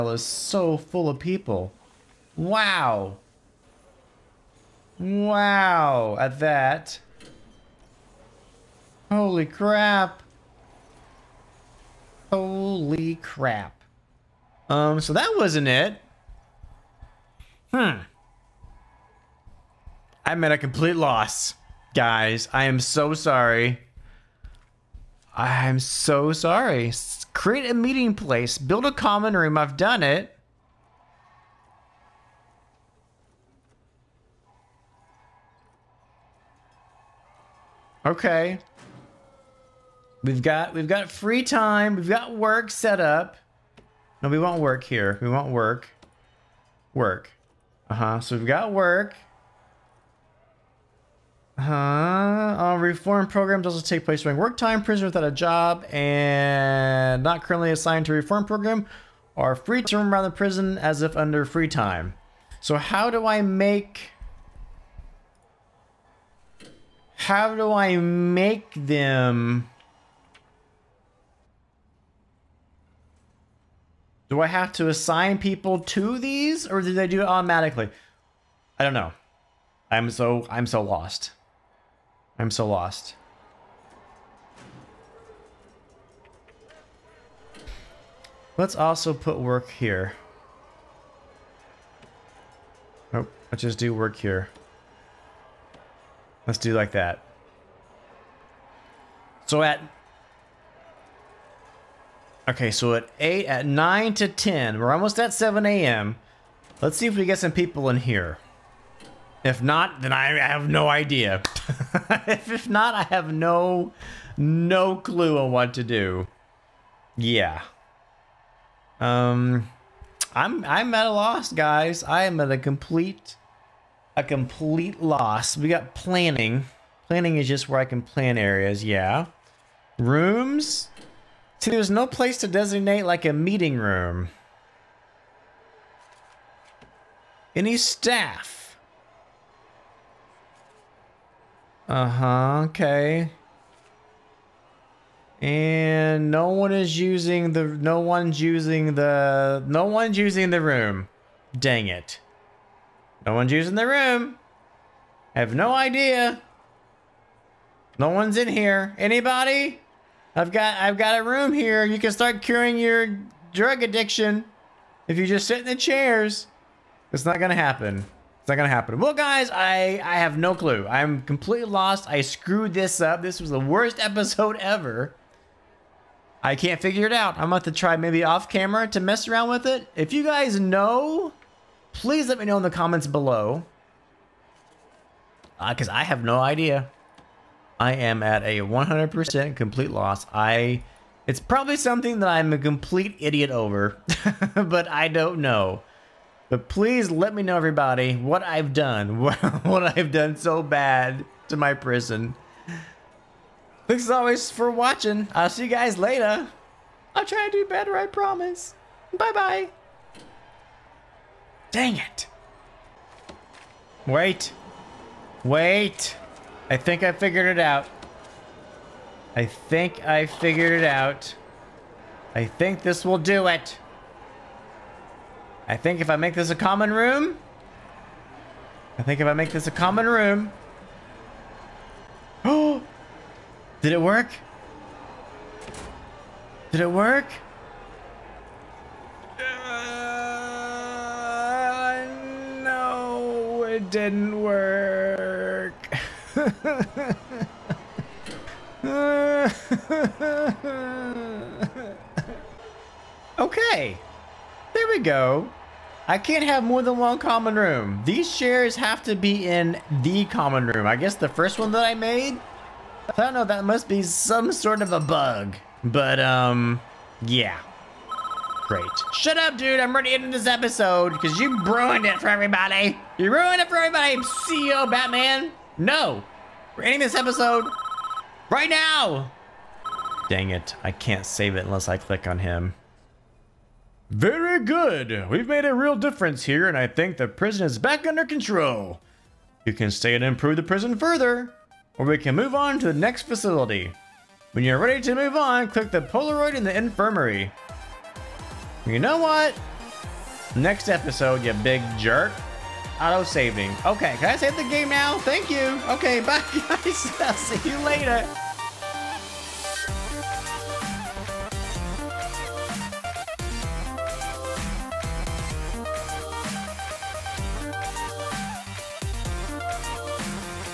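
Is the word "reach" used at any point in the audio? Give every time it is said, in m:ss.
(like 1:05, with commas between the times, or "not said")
not said.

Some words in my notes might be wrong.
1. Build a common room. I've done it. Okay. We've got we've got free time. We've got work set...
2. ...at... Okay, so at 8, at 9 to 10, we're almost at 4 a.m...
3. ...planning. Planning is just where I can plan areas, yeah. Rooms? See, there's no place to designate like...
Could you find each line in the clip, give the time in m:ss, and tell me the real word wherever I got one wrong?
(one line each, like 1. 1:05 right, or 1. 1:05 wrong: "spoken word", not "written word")
1. 0:28 right
2. 1:39 wrong: "7", not "4"
3. 2:05 right.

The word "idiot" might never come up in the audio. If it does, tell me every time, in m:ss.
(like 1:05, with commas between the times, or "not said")
3:13.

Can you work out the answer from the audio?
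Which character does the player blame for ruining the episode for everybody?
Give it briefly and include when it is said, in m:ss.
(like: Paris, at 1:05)
CEO Batman, at 4:34.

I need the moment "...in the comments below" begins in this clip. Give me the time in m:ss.
3:02.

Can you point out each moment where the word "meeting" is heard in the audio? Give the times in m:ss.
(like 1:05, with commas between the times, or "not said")
0:27, 2:13.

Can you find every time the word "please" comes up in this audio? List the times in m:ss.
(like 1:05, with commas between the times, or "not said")
3:01, 3:16.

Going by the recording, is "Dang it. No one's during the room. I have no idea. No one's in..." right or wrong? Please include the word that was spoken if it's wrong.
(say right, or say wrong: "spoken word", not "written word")
wrong: "using", not "during".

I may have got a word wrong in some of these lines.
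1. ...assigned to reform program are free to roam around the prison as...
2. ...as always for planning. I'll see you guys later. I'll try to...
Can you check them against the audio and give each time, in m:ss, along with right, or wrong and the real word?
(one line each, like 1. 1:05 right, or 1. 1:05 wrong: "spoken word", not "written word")
1. 0:57 right
2. 3:24 wrong: "watching", not "planning".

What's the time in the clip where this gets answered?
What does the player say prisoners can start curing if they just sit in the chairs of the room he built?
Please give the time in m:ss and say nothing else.
2:43.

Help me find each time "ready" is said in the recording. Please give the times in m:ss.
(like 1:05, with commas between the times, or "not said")
4:29, 4:54.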